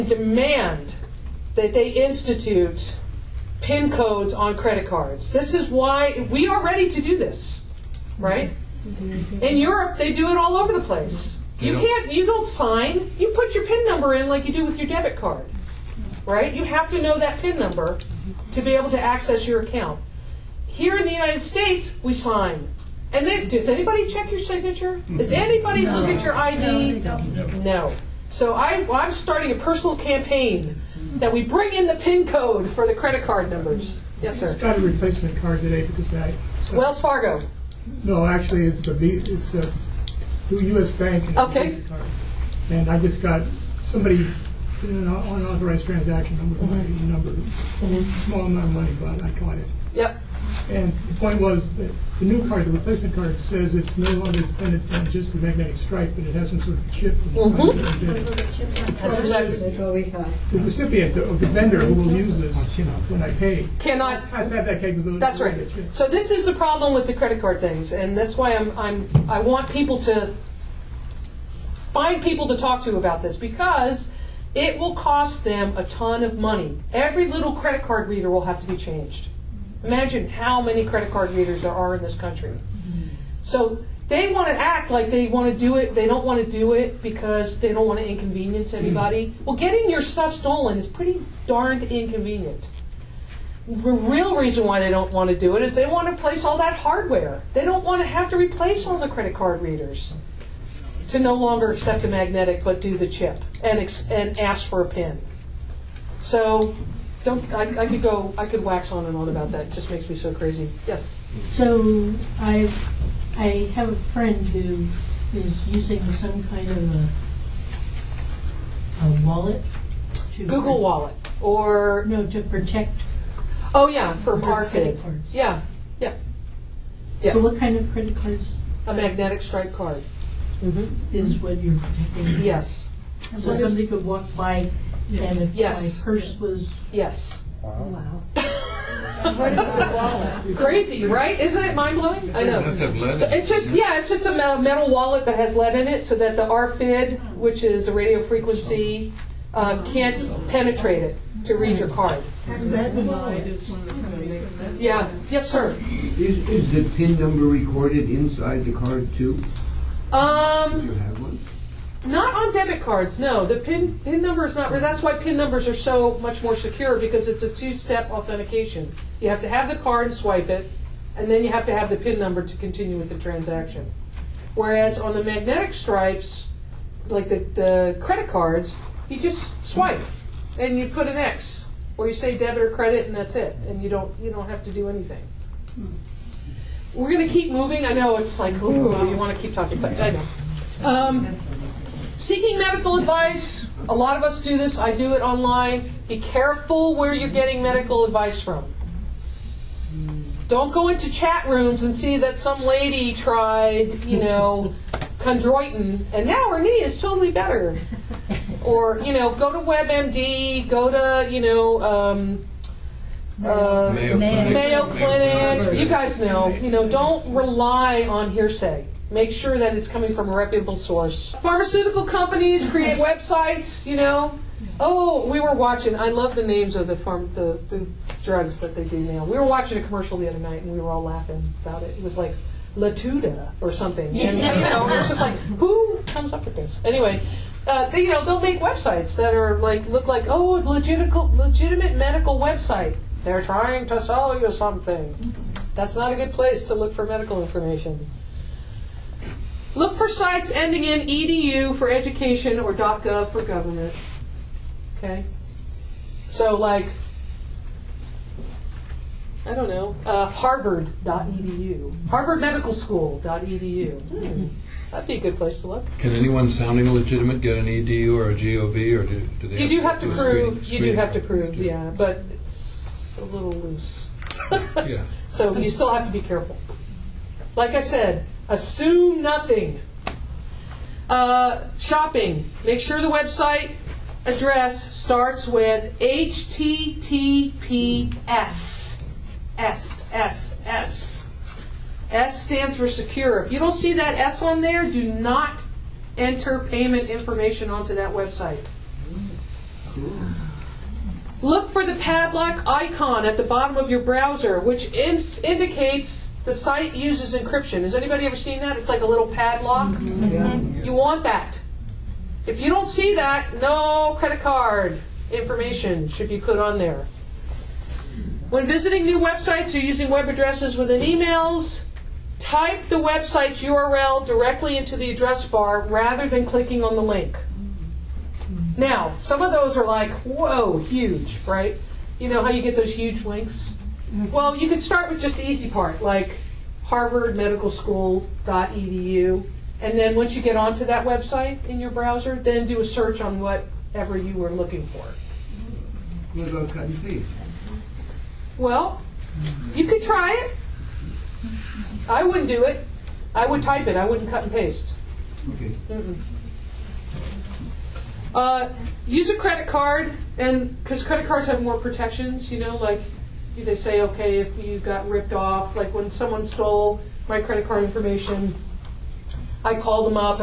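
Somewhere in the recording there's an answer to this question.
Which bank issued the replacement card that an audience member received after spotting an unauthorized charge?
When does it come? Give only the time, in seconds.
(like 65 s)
40 s.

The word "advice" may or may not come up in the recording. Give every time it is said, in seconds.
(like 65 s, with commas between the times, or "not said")
192 s, 198 s.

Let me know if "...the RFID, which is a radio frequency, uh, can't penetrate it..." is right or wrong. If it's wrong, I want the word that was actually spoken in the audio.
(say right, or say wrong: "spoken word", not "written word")
right.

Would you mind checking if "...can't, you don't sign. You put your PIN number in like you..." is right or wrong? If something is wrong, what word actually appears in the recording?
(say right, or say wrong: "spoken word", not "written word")
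right.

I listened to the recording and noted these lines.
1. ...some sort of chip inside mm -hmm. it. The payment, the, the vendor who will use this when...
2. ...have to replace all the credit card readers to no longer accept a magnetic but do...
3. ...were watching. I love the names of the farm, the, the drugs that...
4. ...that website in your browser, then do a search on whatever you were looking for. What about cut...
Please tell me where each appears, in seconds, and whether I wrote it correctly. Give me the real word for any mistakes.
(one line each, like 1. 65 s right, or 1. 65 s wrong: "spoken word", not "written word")
1. 56 s wrong: "recipient", not "payment"
2. 98 s right
3. 225 s right
4. 340 s right.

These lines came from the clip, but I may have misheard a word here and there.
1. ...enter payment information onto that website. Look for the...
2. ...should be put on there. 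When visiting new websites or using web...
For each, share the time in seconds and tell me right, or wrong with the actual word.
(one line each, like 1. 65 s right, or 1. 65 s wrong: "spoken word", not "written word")
1. 296 s right
2. 316 s right.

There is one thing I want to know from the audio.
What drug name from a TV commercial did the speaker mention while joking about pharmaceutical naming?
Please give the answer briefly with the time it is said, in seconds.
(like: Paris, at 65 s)
Latuda, at 232 s.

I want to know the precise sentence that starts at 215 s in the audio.
You guys know, you know, don't rely on hearsay make sure that it's coming from a reputable source.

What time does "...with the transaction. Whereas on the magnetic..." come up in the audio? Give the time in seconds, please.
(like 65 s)
172 s.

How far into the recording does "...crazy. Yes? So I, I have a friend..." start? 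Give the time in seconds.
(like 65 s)
110 s.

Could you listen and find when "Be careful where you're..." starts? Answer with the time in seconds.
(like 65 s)
196 s.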